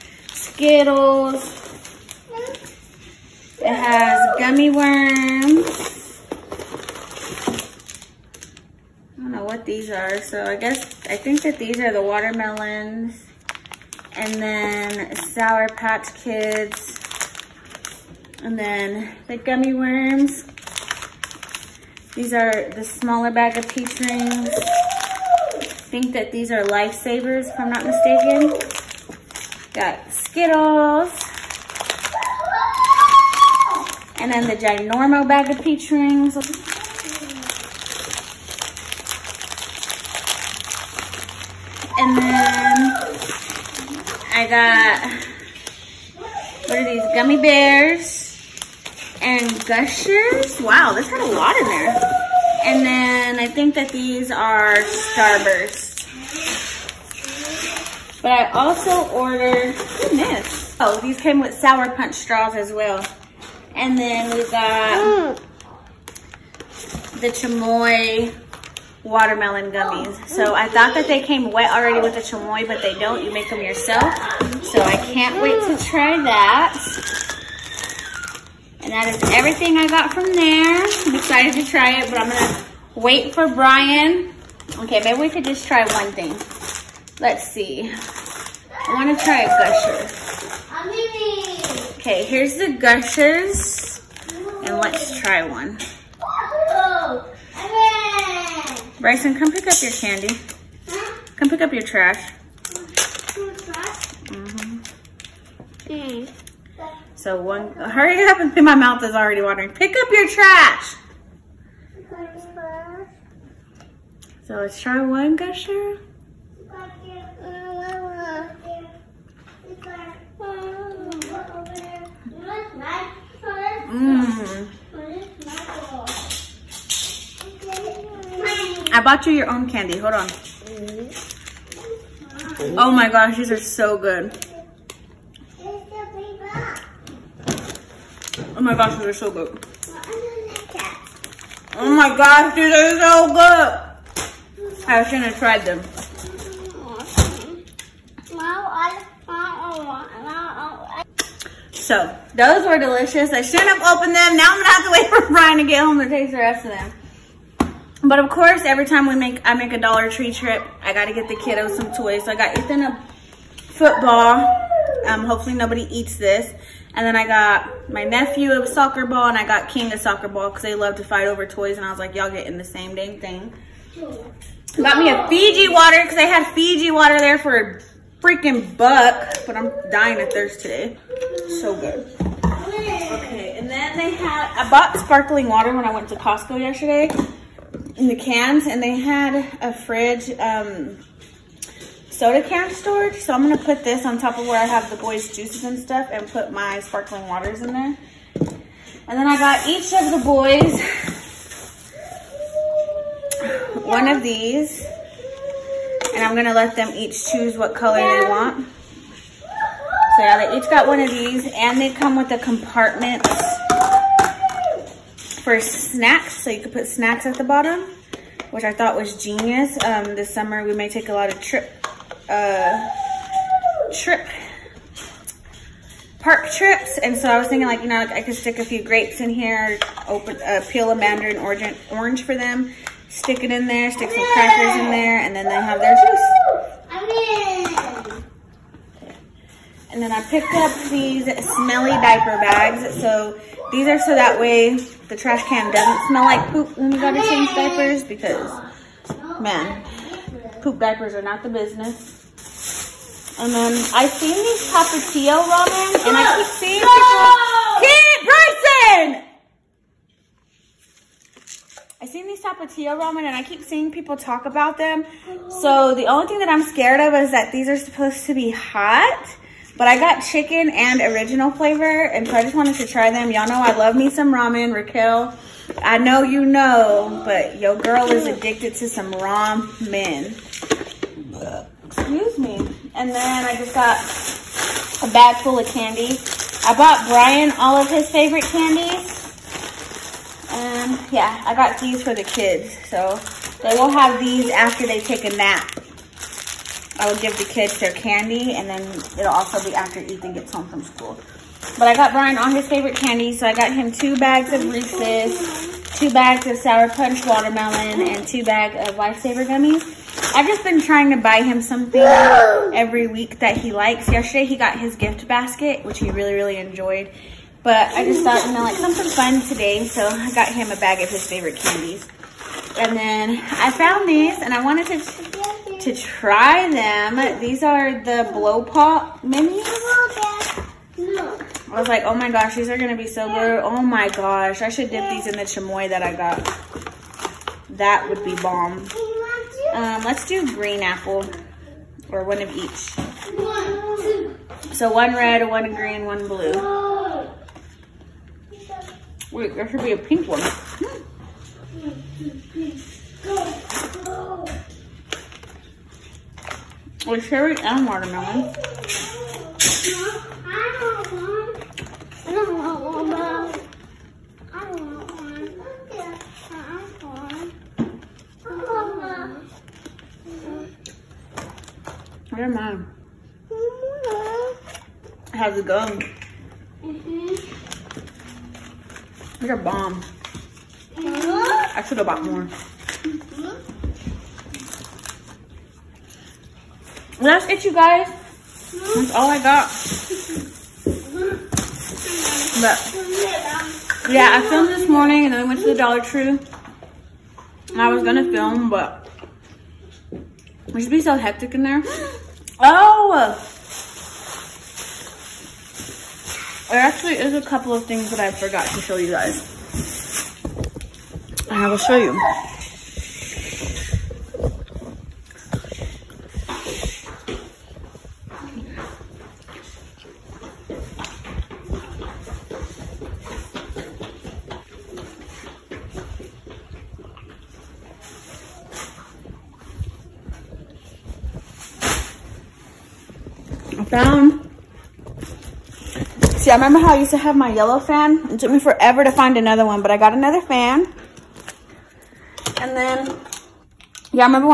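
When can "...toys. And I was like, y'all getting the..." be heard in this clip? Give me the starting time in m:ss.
2:51.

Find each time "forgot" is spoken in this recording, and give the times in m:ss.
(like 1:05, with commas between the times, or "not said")
6:48.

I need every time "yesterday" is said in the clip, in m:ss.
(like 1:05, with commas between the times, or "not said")
3:06, 5:14.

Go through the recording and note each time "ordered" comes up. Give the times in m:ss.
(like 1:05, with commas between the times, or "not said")
0:59.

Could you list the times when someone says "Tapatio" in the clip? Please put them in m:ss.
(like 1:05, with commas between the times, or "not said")
4:14, 4:22.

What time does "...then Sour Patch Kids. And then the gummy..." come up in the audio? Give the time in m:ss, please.
0:14.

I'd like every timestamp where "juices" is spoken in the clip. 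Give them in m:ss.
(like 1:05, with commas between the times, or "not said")
3:15, 3:55.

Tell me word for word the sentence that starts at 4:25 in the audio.
So the only thing that I'm scared of is that these are supposed to be hot.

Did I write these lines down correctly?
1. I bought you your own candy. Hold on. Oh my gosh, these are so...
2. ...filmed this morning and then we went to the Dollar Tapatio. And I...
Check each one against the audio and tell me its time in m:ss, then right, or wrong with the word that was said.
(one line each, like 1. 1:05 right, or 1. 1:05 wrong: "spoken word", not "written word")
1. 2:08 right
2. 6:34 wrong: "Tree", not "Tapatio".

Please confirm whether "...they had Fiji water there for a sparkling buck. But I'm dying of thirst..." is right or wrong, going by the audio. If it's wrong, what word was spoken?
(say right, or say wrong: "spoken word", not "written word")
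wrong: "freaking", not "sparkling".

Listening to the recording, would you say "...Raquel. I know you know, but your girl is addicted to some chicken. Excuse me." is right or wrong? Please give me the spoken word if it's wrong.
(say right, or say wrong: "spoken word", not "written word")
wrong: "ramen", not "chicken".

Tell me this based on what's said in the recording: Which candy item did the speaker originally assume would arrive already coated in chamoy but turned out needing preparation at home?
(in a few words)
watermelon gummies.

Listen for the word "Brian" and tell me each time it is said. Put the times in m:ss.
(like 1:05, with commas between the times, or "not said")
1:23, 2:35, 4:47, 5:02.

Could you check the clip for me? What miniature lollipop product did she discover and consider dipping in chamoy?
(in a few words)
blow pop minis.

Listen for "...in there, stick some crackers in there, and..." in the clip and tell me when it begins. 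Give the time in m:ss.
3:53.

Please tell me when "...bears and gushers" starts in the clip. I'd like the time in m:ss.
0:47.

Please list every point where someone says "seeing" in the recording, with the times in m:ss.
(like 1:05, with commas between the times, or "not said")
4:16, 4:23.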